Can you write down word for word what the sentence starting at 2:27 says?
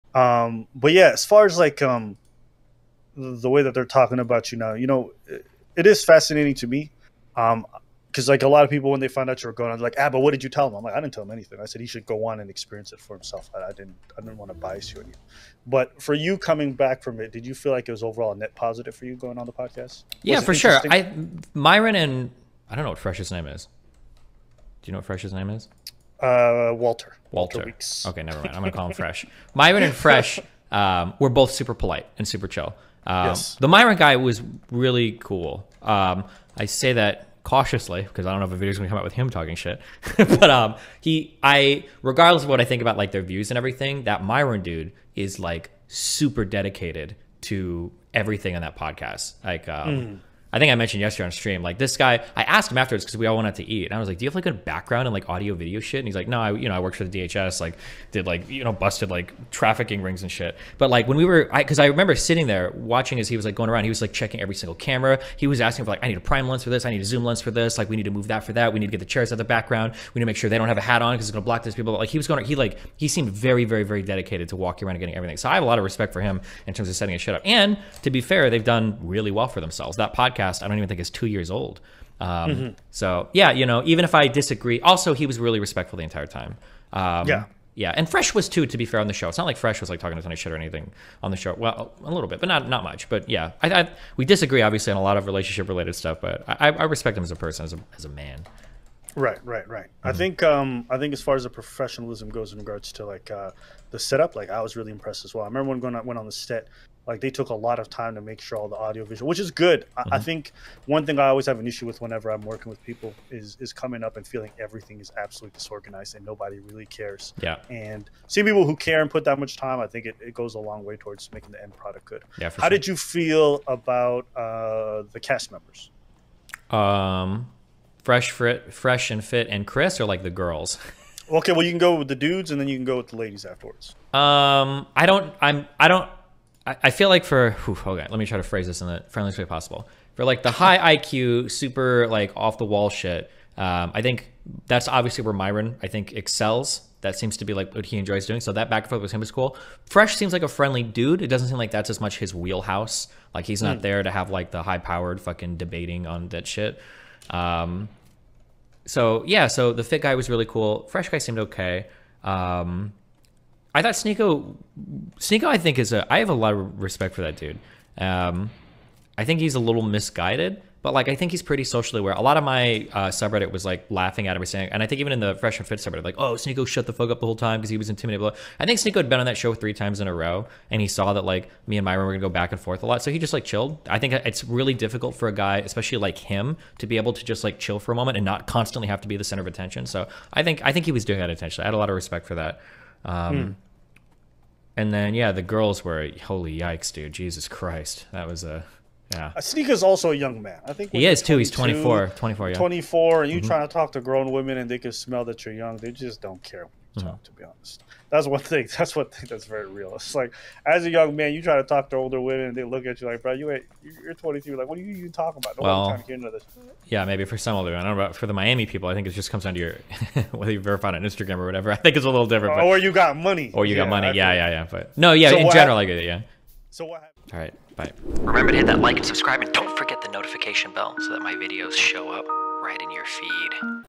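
That seems to be like what he enjoys doing.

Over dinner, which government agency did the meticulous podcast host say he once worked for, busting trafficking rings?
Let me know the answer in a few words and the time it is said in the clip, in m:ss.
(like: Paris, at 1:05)
DHS, at 0:57.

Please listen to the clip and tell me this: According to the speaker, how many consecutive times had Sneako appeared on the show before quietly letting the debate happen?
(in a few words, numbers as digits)
3 times.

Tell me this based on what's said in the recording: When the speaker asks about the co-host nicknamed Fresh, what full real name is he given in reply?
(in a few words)
Walter Weeks.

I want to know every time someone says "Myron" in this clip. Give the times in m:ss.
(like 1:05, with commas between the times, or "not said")
0:21, 0:29, 0:33, 0:44, 2:25, 3:01.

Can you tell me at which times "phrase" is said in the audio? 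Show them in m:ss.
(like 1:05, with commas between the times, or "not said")
2:18.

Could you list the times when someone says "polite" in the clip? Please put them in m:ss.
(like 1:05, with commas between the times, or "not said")
0:31.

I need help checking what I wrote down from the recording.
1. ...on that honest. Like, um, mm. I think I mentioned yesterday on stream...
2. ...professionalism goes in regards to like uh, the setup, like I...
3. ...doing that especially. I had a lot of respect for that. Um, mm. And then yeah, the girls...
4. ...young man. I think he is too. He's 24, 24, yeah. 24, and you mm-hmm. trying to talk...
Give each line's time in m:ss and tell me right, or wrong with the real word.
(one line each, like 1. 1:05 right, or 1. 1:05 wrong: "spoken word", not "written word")
1. 0:48 wrong: "podcast", not "honest"
2. 1:41 right
3. 3:11 wrong: "intentionally", not "especially"
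4. 3:20 right.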